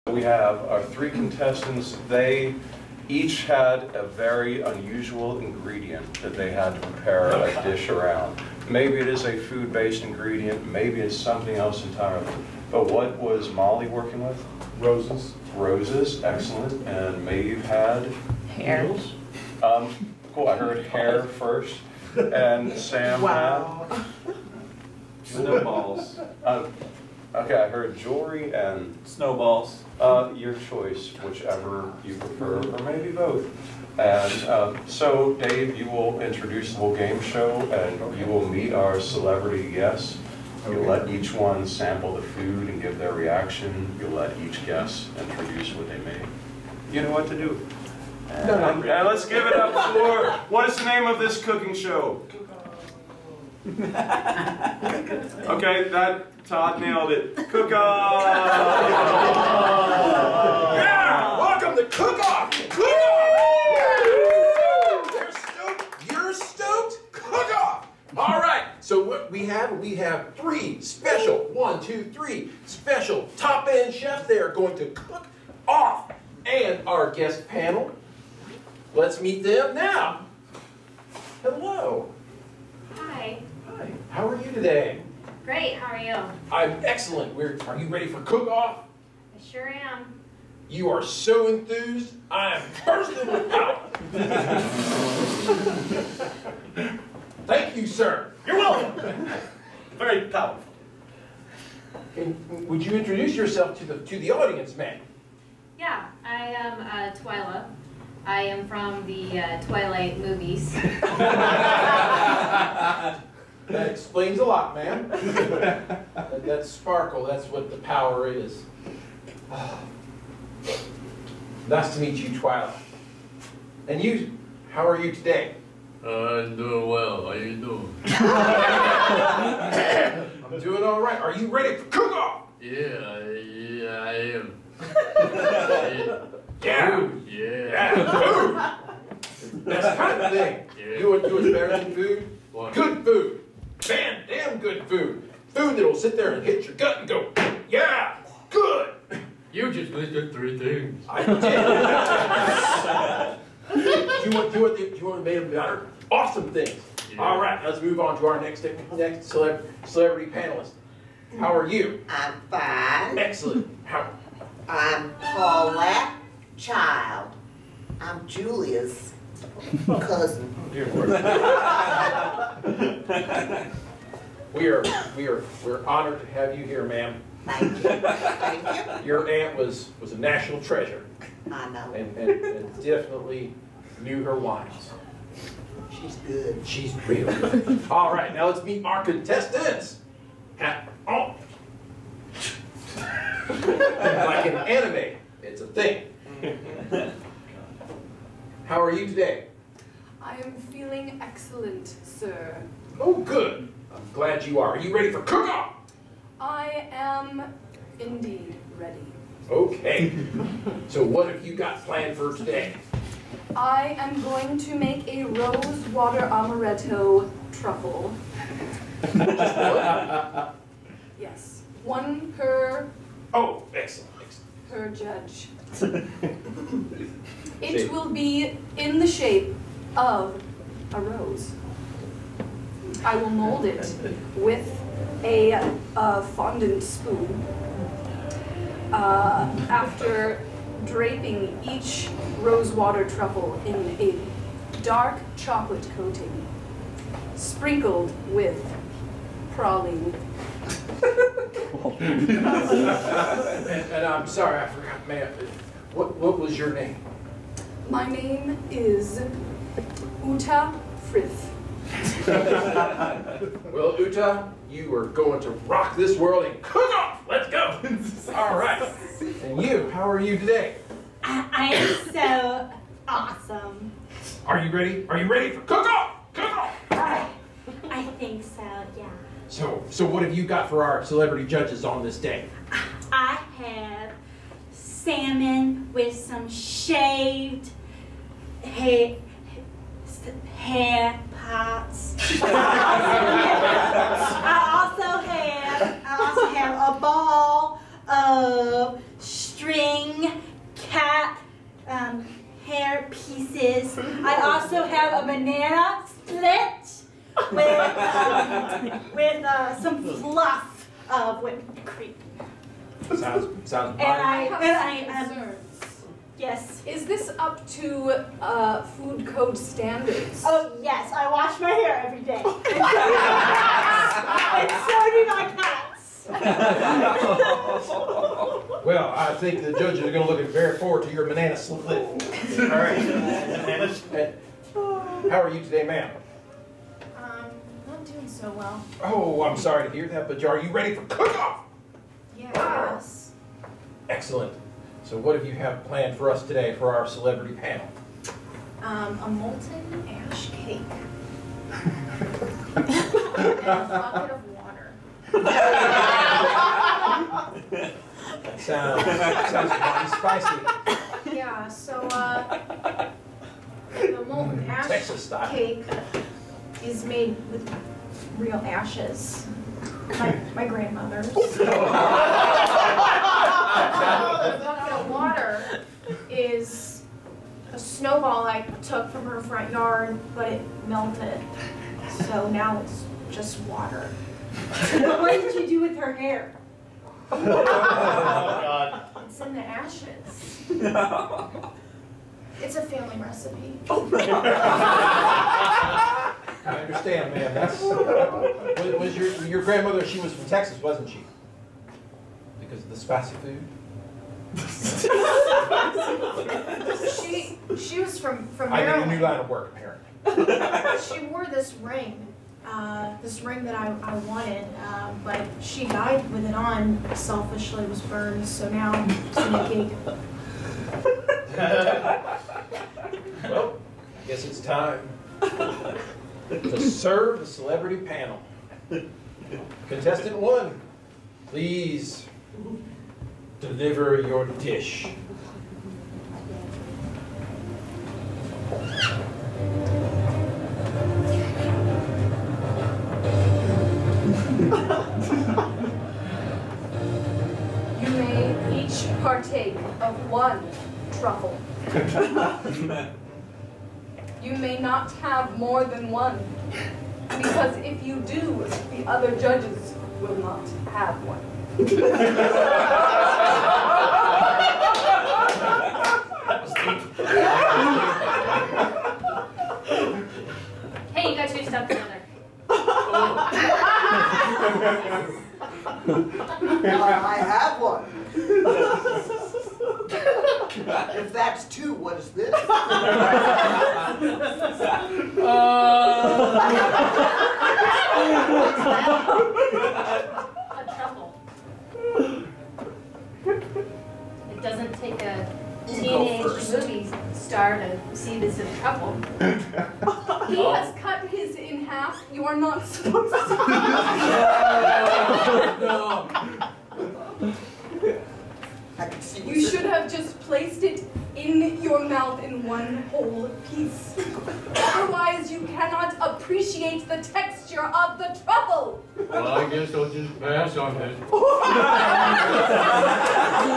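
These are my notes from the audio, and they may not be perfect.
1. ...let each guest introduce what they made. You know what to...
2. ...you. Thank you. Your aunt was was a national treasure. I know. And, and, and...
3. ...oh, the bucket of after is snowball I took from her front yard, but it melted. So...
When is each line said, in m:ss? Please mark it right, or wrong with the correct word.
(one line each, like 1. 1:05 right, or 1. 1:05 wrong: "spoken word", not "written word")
1. 0:44 right
2. 2:57 right
3. 6:11 wrong: "water", not "after".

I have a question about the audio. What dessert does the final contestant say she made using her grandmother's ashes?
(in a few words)
Molten ash cake.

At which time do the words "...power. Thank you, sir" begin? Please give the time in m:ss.
1:36.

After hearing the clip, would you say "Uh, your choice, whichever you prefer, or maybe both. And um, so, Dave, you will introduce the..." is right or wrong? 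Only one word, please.
right.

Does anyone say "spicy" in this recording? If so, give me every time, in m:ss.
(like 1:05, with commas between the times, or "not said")
6:00, 6:42.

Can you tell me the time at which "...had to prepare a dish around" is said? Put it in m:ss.
0:06.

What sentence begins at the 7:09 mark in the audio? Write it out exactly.
Contestant one, please deliver your dish.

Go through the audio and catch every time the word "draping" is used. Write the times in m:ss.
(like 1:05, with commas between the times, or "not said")
4:00.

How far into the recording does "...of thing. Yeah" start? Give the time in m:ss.
2:20.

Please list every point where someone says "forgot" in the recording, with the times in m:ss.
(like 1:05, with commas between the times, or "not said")
4:14.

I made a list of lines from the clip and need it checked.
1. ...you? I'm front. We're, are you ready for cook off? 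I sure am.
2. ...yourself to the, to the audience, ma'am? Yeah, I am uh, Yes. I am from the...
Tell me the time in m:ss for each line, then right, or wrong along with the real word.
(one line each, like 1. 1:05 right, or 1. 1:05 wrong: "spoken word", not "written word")
1. 1:25 wrong: "excellent", not "front"
2. 1:43 wrong: "Twyla", not "Yes".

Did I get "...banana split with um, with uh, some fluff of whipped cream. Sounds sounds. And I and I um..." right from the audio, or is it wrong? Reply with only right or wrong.
right.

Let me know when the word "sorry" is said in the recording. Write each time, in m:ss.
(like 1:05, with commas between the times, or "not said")
4:14, 5:39.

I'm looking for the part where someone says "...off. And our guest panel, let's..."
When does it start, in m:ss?
1:15.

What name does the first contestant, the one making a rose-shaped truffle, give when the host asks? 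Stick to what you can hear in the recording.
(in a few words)
Uta Frith.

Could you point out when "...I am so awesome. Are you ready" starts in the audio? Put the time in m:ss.
4:31.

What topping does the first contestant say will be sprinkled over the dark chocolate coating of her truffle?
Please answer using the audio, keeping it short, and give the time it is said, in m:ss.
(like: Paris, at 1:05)
Praline, at 4:09.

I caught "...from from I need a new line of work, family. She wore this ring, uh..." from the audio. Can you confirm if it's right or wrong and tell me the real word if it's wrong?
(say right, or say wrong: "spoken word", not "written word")
wrong: "apparently", not "family".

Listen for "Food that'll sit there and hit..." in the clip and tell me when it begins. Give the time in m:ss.
2:25.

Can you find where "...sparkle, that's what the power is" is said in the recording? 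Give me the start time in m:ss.
1:56.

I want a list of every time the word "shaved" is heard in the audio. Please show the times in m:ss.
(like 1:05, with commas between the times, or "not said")
4:46.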